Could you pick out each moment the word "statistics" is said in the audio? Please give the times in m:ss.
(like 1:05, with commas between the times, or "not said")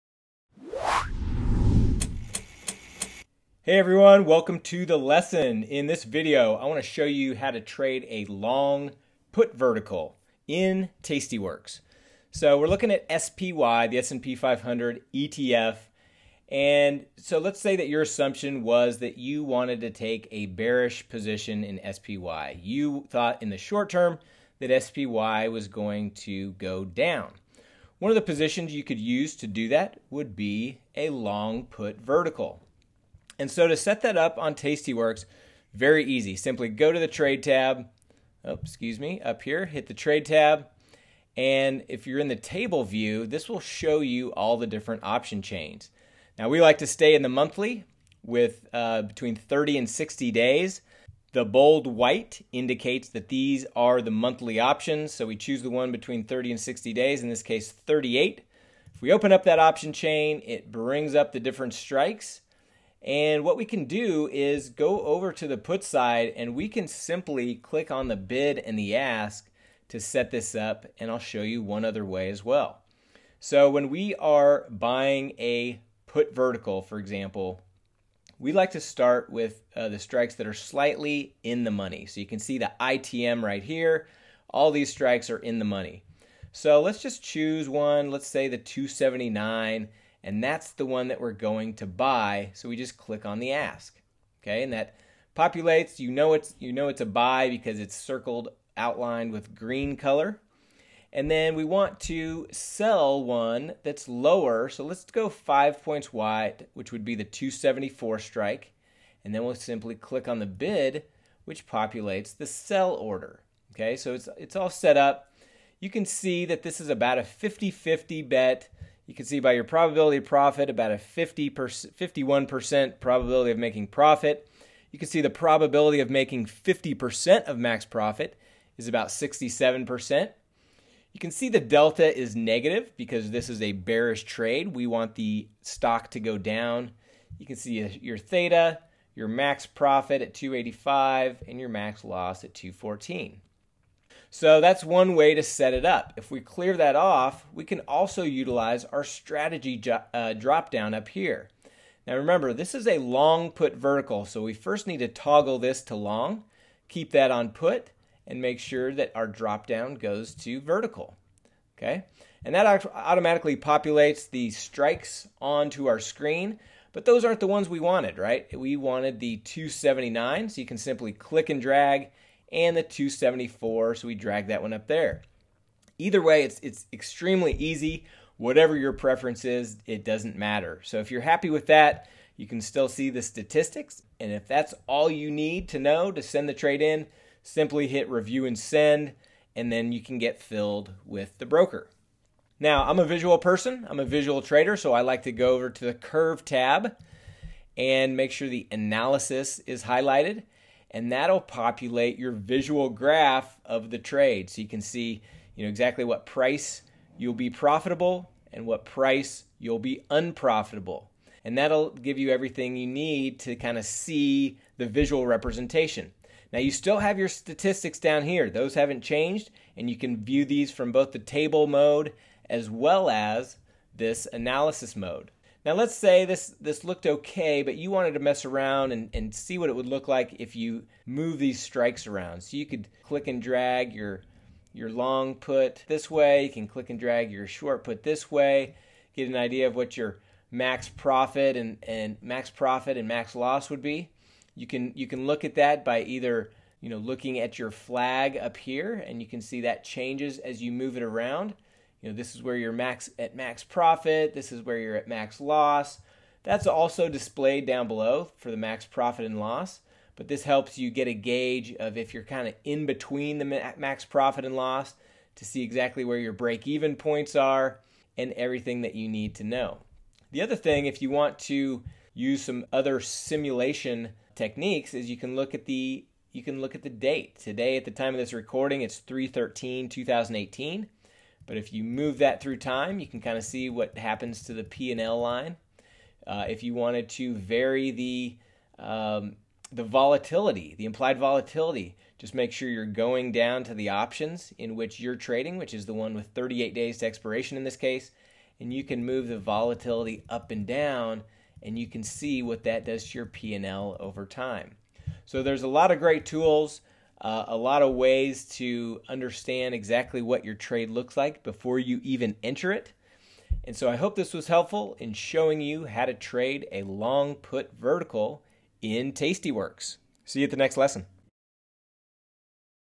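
3:03, 3:37.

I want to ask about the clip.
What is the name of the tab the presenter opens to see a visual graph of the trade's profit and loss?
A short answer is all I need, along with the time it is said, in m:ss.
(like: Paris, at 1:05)
curve tab, at 3:15.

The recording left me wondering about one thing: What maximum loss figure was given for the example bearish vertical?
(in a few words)
214.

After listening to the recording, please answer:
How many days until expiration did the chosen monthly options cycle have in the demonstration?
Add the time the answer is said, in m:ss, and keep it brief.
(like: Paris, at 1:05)
38, at 0:57.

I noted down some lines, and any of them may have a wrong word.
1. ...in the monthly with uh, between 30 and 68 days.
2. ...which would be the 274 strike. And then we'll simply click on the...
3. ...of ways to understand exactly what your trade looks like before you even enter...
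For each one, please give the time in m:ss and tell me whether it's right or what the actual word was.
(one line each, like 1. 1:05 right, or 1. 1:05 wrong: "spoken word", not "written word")
1. 0:47 wrong: "60", not "68"
2. 1:46 right
3. 5:07 right.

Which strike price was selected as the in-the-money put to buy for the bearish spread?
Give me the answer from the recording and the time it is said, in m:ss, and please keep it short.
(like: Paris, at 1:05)
279, at 1:28.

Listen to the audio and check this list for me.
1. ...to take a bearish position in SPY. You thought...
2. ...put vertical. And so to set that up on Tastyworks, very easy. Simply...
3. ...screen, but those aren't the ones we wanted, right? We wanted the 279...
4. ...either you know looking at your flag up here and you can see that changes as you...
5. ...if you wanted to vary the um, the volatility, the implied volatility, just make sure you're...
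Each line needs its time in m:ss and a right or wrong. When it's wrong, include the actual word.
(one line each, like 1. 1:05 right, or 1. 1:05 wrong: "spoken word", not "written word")
1. 0:19 right
2. 0:31 right
3. 2:45 right
4. 4:06 right
5. 4:46 right.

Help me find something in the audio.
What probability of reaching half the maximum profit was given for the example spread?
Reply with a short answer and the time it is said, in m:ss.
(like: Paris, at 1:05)
67%, at 2:08.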